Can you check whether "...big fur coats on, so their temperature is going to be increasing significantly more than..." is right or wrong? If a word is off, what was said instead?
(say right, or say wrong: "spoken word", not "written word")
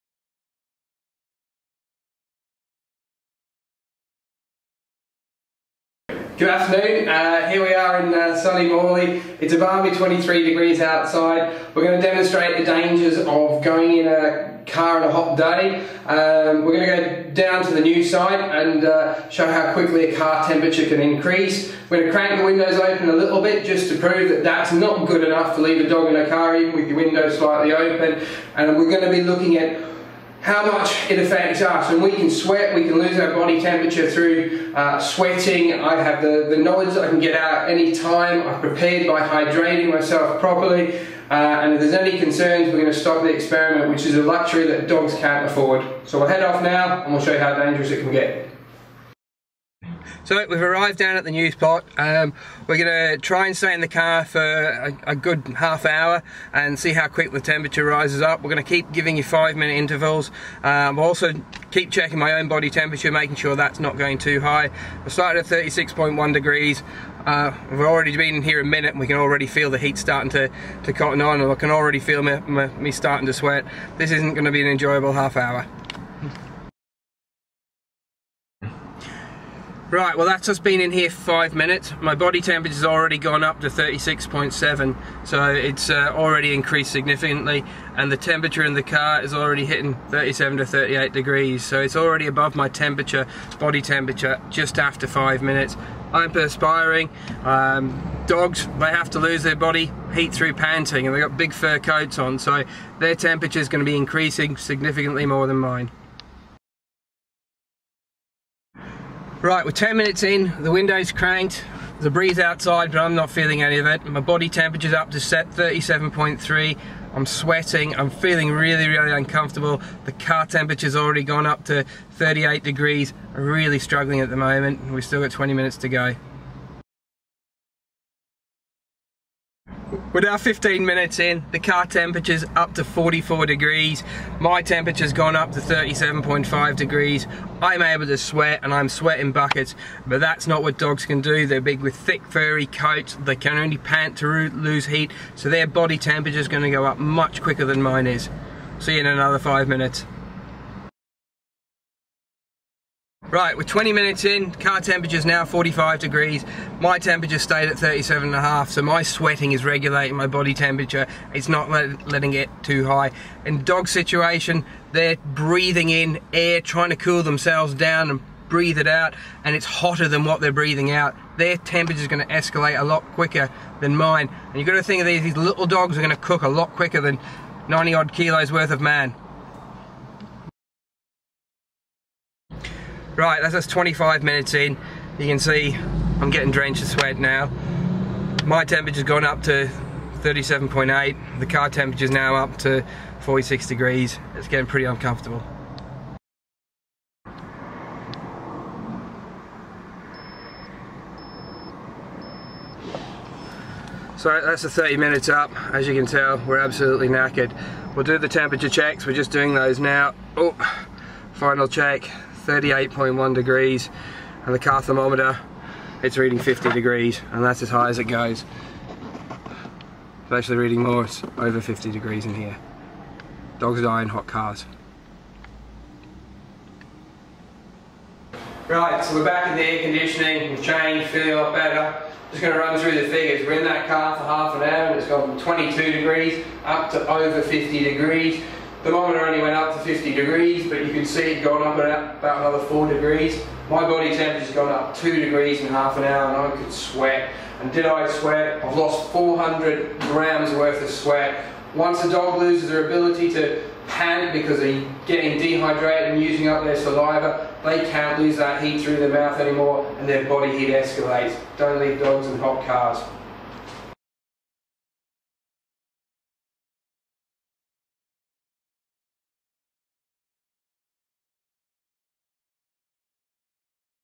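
right.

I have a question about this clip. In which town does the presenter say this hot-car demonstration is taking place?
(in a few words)
Morley.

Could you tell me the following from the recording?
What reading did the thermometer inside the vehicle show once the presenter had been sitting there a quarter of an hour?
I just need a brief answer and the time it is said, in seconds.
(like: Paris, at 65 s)
44 degrees, at 132 s.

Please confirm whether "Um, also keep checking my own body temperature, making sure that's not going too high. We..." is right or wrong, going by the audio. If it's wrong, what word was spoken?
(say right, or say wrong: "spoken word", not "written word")
right.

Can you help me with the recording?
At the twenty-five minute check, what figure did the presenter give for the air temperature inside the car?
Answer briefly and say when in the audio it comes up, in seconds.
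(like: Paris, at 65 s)
46 degrees, at 193 s.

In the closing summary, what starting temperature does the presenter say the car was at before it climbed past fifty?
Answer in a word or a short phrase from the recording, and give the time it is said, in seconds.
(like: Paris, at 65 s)
22 degrees, at 235 s.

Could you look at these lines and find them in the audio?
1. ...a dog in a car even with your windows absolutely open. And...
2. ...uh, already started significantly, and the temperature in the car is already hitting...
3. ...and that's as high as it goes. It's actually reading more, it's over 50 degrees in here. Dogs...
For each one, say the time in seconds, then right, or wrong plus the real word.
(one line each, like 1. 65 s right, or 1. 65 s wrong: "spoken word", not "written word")
1. 25 s wrong: "slightly", not "absolutely"
2. 85 s wrong: "increased", not "started"
3. 217 s right.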